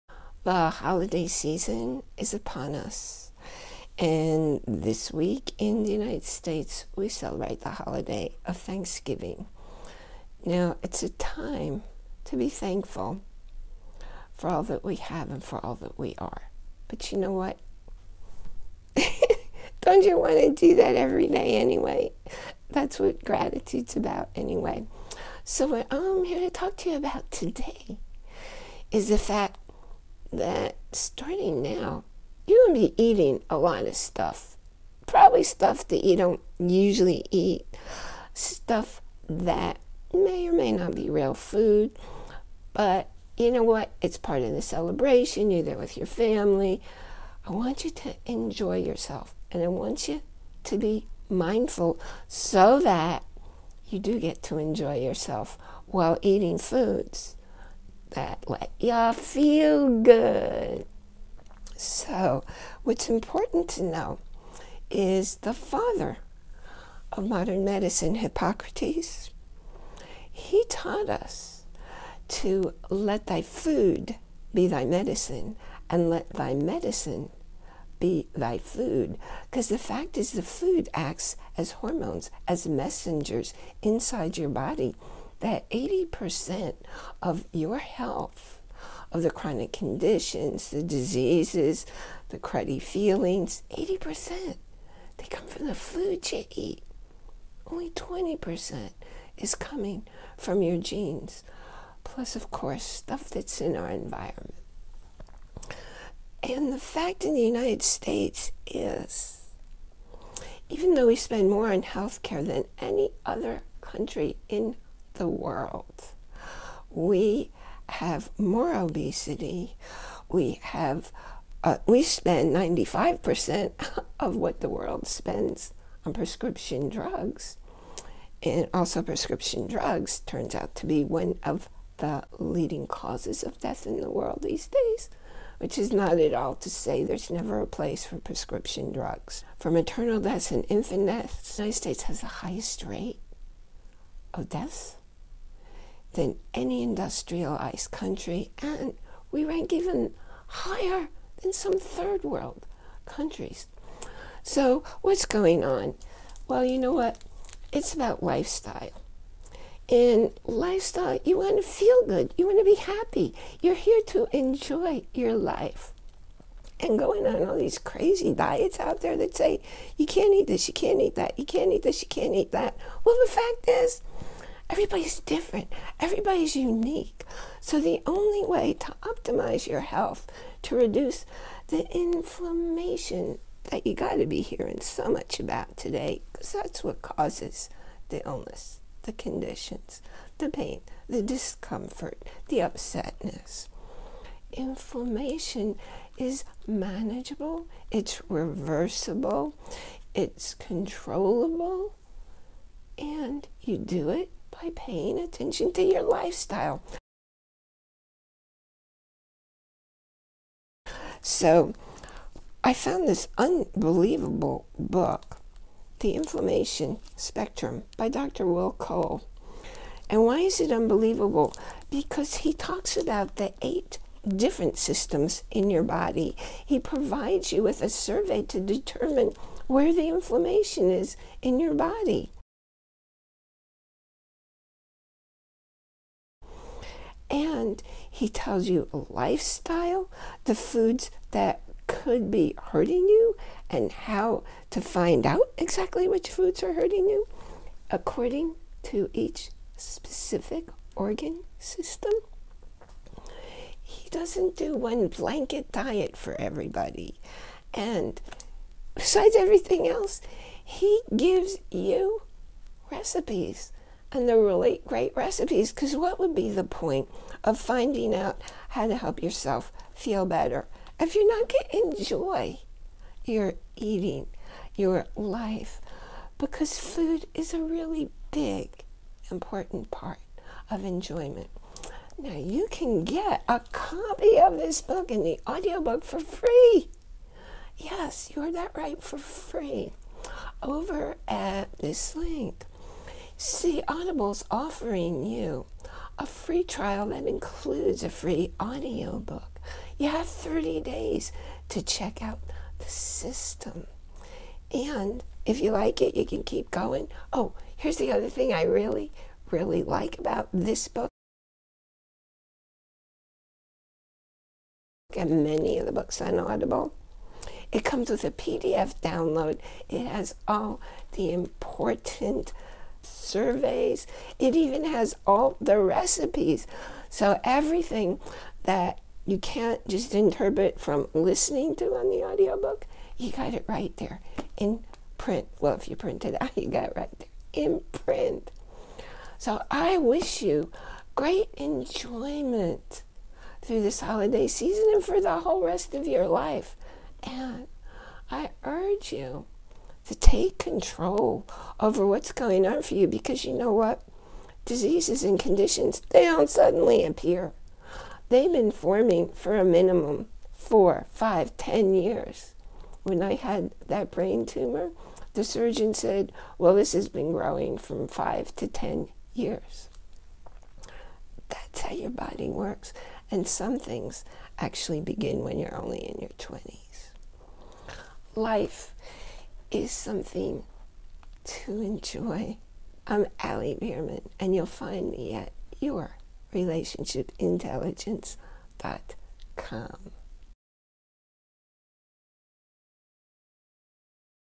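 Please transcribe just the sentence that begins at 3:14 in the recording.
Inflammation is manageable, it's reversible, it's controllable, and you do it by paying attention to your lifestyle.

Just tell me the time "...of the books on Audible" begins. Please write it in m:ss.
5:15.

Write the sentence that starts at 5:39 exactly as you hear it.
So I wish you great enjoyment through this holiday season and for the whole rest of your life.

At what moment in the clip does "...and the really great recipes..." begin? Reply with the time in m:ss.
4:24.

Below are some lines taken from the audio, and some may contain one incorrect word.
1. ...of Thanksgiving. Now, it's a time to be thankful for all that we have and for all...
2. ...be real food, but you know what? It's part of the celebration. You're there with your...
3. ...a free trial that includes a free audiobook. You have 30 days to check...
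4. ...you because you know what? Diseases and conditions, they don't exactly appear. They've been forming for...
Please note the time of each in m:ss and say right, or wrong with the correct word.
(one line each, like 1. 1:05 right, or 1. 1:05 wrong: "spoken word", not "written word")
1. 0:08 right
2. 0:40 right
3. 4:56 right
4. 5:52 wrong: "suddenly", not "exactly".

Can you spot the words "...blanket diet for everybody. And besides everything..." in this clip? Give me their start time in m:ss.
4:15.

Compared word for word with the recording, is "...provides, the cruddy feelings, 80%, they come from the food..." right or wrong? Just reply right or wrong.
wrong.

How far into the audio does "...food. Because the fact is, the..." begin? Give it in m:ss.
1:18.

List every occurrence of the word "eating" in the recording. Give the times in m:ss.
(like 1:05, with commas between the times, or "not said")
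0:33, 0:56, 4:33.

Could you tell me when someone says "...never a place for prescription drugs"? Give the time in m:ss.
2:17.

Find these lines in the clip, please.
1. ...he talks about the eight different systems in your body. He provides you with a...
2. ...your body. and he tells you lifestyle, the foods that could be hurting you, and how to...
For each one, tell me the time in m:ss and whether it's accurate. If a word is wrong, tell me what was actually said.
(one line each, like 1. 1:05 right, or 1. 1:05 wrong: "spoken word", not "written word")
1. 3:42 right
2. 3:51 right.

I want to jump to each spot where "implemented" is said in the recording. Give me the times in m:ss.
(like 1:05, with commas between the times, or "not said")
not said.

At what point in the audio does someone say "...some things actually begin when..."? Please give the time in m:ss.
6:13.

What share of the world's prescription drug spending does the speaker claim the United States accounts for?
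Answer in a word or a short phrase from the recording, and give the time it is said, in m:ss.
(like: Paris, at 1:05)
95%, at 2:02.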